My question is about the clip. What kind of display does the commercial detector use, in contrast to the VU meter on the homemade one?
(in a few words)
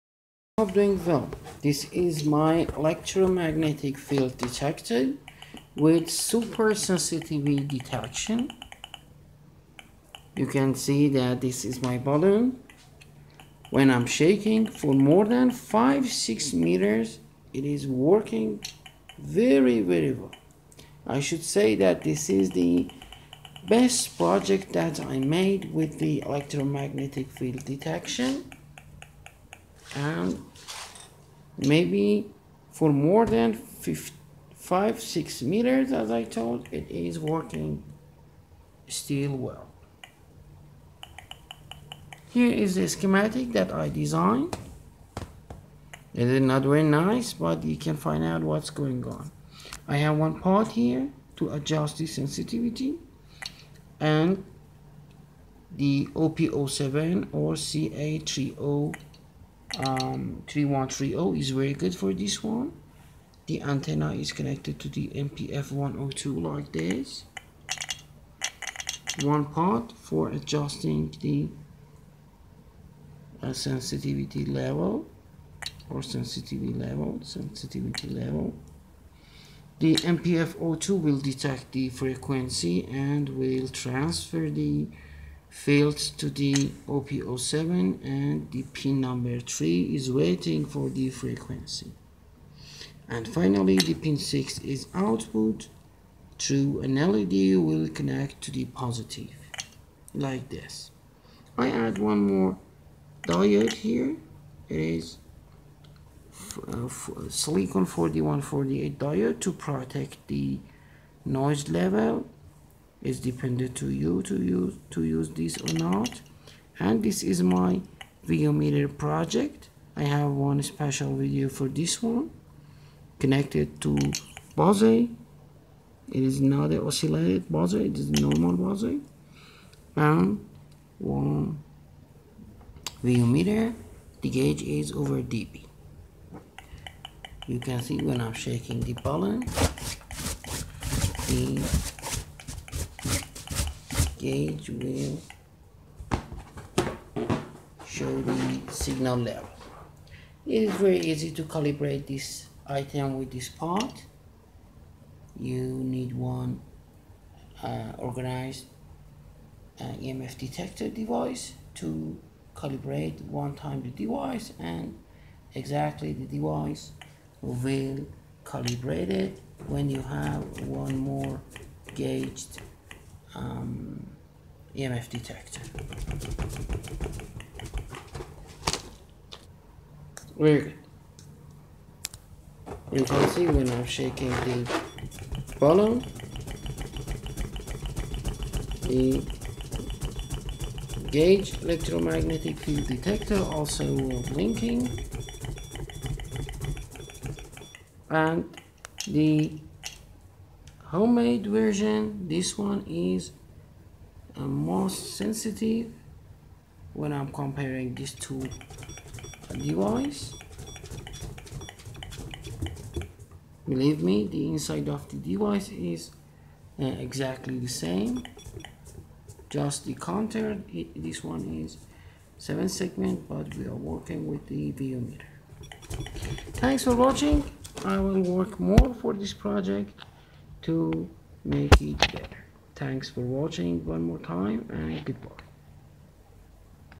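7 segment.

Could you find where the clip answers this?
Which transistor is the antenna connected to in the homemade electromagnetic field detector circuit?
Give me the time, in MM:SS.
01:05.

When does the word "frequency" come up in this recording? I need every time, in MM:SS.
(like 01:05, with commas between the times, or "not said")
01:21, 01:31.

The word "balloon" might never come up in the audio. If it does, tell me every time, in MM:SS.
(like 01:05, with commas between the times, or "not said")
00:11, 02:18.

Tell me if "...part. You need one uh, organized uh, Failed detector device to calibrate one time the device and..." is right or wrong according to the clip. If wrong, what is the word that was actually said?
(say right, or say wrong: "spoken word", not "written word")
wrong: "EMF", not "Failed".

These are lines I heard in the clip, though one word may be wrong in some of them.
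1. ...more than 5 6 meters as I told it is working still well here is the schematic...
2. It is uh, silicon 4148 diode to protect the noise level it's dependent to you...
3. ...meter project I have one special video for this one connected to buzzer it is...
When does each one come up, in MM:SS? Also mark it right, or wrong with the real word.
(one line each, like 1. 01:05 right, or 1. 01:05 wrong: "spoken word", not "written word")
1. 00:32 right
2. 01:44 right
3. 01:58 right.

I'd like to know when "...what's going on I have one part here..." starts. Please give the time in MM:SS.
00:48.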